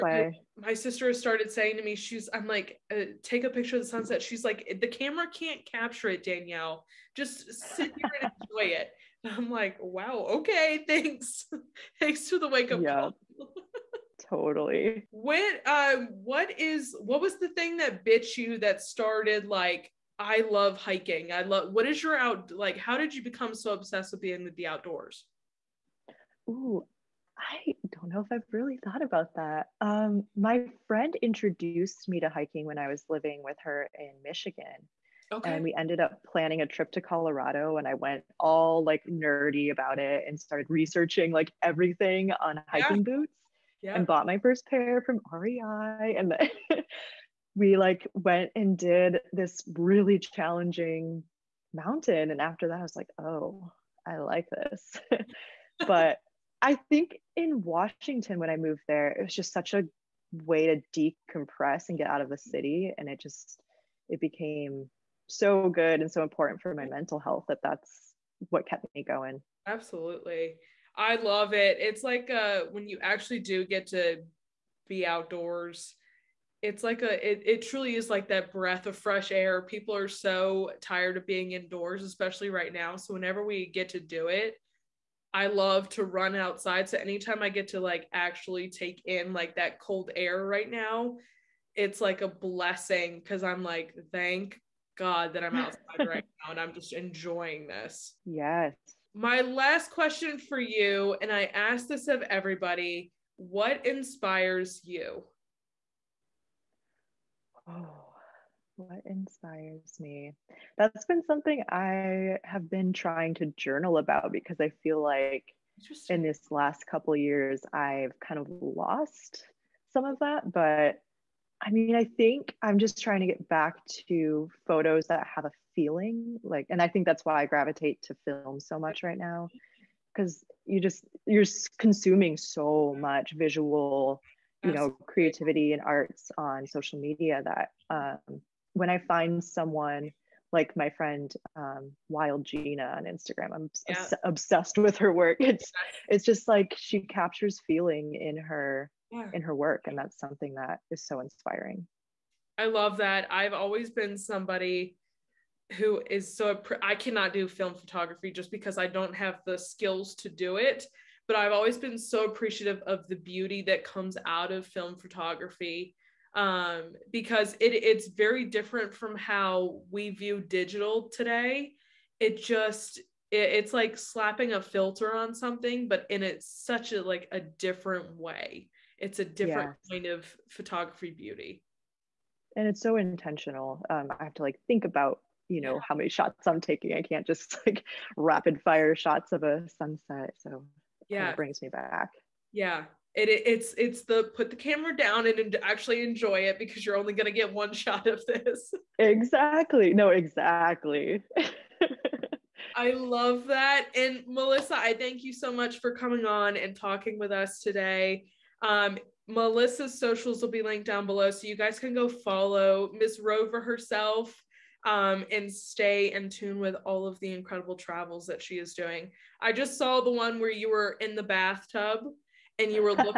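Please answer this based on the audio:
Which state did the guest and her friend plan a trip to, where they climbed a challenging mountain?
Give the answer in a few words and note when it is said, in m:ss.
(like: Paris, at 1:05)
Colorado, at 0:37.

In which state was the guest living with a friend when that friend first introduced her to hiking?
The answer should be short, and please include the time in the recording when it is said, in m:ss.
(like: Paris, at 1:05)
Michigan, at 0:34.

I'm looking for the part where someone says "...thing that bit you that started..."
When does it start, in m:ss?
0:17.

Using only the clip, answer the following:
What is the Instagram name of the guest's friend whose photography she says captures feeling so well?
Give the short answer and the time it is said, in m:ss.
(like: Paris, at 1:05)
wild gina, at 2:22.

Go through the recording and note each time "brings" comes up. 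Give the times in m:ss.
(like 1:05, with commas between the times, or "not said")
3:11.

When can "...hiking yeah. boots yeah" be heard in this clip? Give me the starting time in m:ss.
0:42.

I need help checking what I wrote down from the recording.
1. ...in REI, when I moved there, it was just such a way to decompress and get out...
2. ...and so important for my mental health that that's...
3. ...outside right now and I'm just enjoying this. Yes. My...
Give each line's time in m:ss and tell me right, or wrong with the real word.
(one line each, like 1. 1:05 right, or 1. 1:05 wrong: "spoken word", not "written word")
1. 0:57 wrong: "Washington", not "REI"
2. 1:06 right
3. 1:35 right.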